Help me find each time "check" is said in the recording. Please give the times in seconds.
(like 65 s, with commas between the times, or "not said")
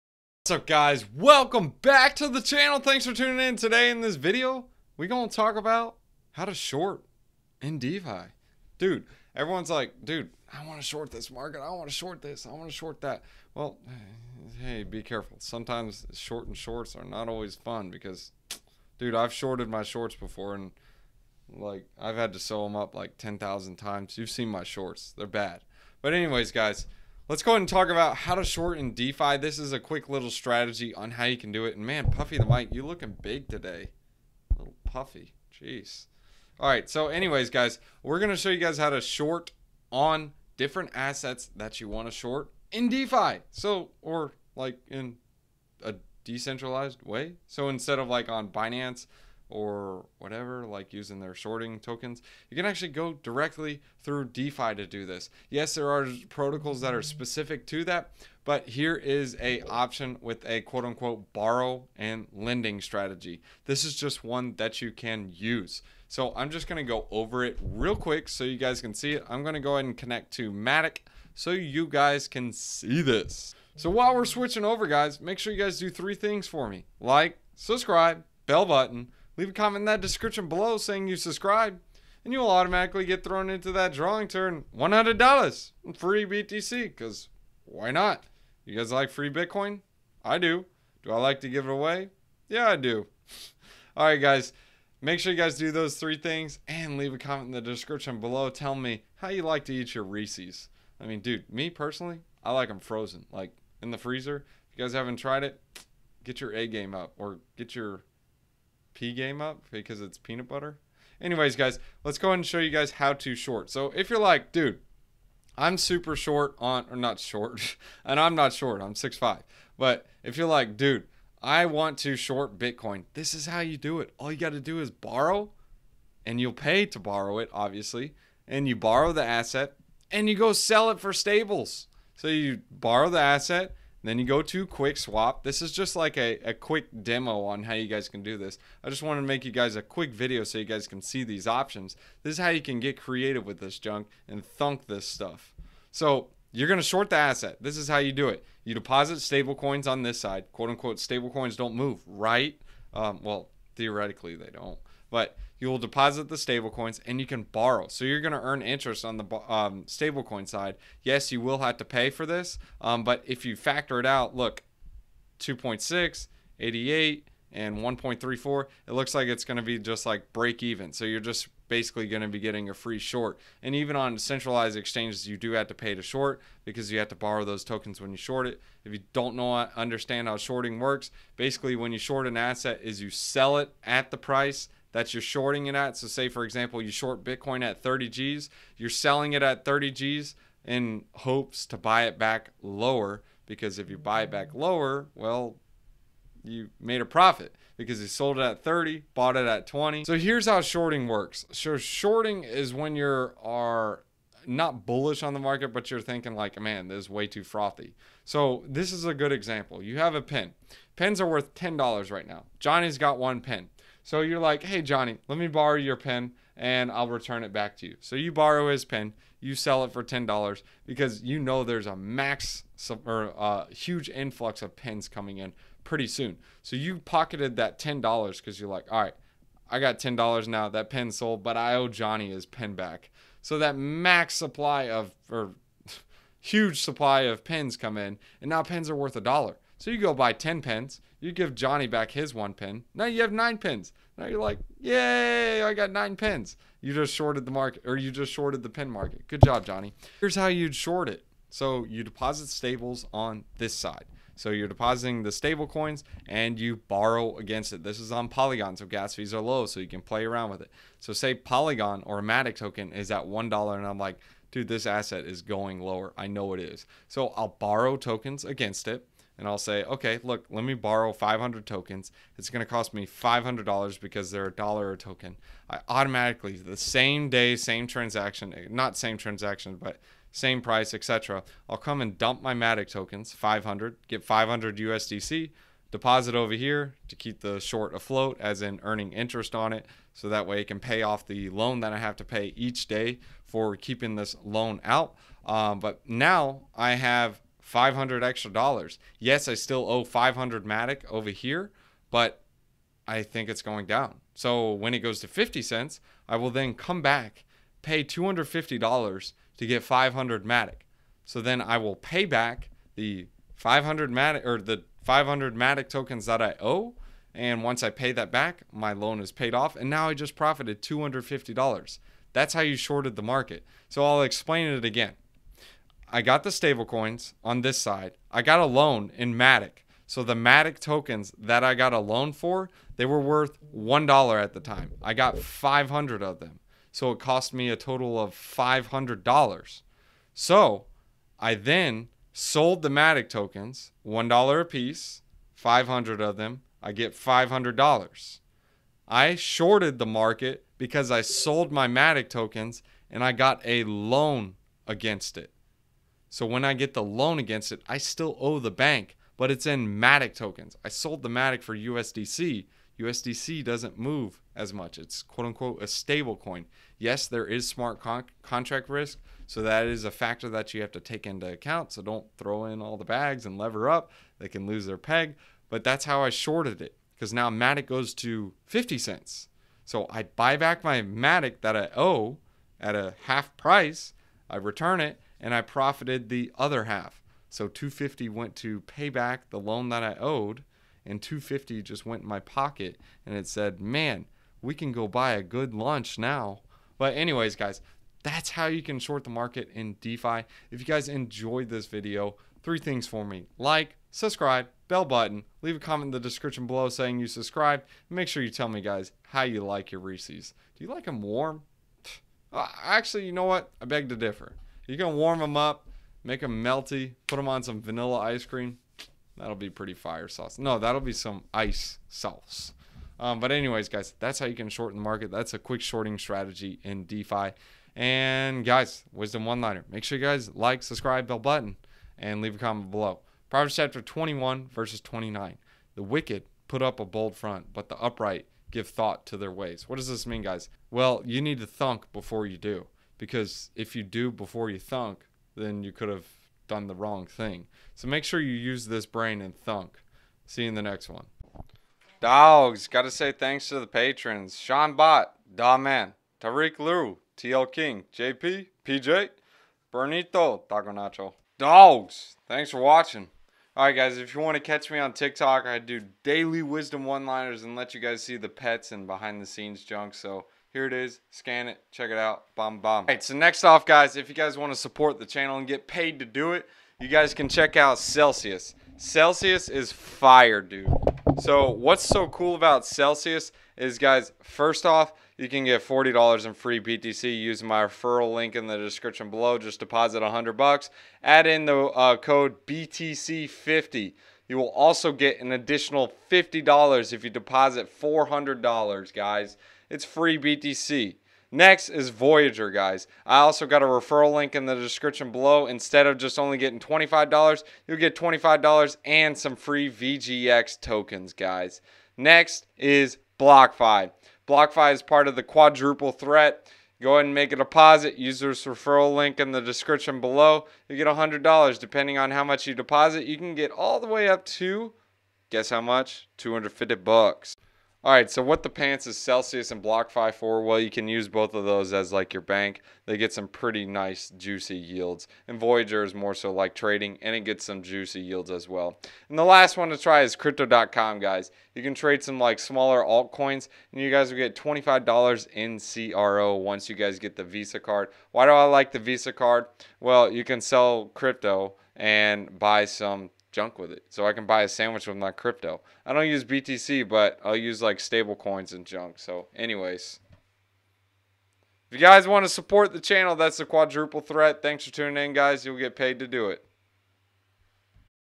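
471 s, 477 s.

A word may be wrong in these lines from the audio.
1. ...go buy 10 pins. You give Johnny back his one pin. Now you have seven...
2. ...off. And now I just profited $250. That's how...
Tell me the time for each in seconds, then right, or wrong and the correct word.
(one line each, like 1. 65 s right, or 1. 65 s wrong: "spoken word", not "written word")
1. 239 s wrong: "nine", not "seven"
2. 319 s right.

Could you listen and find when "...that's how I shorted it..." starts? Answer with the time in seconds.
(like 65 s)
375 s.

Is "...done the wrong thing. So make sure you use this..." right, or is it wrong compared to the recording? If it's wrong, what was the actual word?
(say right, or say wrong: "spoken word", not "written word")
right.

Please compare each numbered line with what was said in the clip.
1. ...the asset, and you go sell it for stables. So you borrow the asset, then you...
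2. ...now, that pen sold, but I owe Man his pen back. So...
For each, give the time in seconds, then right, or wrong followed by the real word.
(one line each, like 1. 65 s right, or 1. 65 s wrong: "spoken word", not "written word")
1. 129 s right
2. 230 s wrong: "Johnny", not "Man".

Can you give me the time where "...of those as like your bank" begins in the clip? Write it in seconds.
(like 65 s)
531 s.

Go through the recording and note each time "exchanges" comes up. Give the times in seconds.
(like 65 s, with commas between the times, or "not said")
174 s.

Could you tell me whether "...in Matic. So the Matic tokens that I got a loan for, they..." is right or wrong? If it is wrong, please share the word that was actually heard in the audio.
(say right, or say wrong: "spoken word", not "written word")
right.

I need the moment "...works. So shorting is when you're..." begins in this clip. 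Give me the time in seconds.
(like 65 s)
201 s.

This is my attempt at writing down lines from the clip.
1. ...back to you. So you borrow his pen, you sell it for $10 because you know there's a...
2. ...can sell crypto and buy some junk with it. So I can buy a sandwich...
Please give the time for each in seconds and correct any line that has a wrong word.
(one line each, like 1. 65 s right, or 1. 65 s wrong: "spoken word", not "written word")
1. 217 s right
2. 550 s right.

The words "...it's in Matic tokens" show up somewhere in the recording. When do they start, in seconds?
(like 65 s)
359 s.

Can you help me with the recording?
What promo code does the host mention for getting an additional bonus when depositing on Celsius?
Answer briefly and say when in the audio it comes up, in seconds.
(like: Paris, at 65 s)
BTC50, at 492 s.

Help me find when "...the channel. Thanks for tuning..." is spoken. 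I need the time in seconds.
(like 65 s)
2 s.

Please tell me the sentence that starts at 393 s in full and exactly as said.
And it said, man, we can go buy a good lunch now.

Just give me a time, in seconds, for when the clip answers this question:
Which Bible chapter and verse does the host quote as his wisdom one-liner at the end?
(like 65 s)
433 s.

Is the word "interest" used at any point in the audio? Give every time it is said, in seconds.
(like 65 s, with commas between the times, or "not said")
158 s, 289 s.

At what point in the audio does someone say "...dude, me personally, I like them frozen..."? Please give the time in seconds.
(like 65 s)
101 s.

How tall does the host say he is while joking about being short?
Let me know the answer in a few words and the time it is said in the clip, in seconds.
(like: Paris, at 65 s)
6'5, at 118 s.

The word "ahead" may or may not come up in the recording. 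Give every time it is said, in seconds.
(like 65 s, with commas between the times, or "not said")
27 s, 69 s, 112 s, 517 s.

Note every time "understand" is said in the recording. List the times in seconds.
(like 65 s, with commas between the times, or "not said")
179 s.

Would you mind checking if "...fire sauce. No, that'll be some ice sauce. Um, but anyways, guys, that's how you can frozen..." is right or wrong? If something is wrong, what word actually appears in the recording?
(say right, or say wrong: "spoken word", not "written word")
wrong: "shorten", not "frozen".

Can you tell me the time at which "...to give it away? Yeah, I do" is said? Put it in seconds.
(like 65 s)
91 s.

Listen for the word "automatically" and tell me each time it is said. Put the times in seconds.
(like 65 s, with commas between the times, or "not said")
82 s, 275 s.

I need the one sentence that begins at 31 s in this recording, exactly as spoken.
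And man, Puffy the mic, you looking big today.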